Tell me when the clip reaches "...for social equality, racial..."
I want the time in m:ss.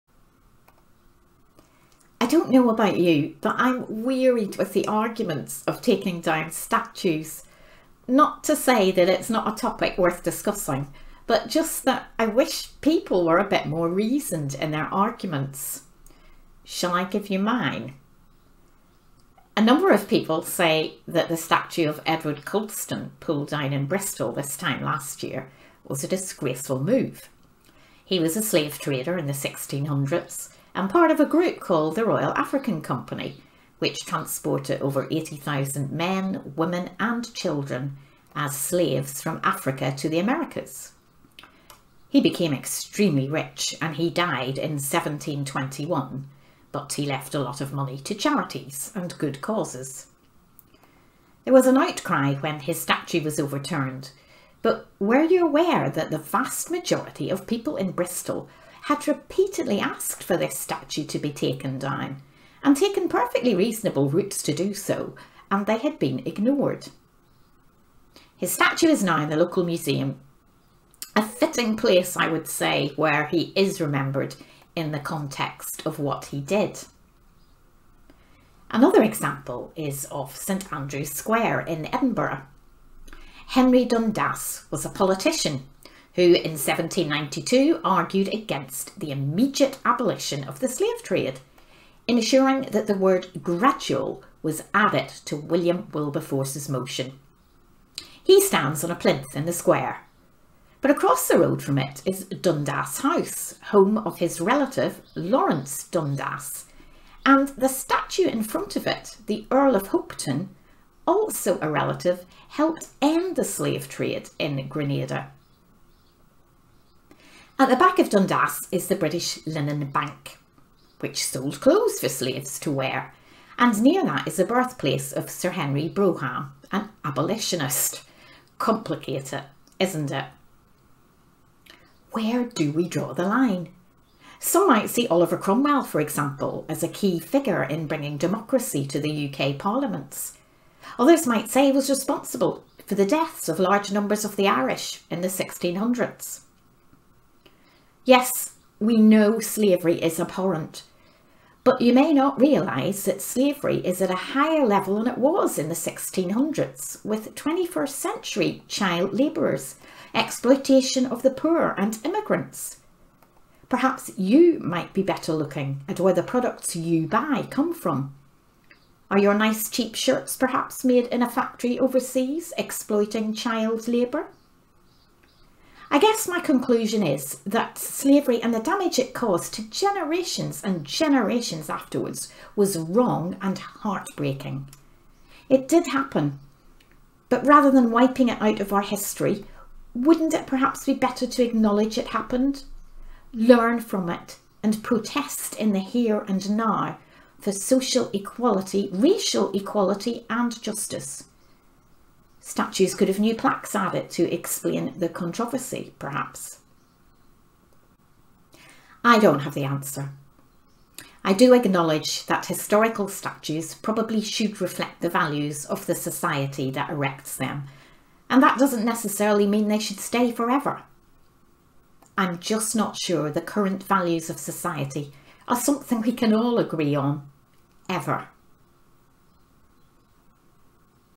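3:17.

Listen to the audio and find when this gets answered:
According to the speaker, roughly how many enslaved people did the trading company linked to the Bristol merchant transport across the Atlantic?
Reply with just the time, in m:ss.
0:34.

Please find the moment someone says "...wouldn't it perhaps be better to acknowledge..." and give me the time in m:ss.
3:09.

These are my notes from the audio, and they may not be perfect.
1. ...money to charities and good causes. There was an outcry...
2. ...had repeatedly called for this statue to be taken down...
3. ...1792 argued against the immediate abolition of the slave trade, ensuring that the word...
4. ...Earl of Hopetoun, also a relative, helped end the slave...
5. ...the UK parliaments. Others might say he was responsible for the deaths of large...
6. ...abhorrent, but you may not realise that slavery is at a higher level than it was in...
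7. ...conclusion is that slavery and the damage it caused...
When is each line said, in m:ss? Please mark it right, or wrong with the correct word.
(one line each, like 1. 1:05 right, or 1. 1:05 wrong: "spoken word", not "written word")
1. 0:47 right
2. 0:58 wrong: "asked", not "called"
3. 1:26 right
4. 1:49 right
5. 2:18 right
6. 2:30 right
7. 2:56 right.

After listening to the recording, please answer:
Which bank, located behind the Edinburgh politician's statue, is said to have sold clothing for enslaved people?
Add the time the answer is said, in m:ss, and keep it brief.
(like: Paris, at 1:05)
British Linen Bank, at 1:58.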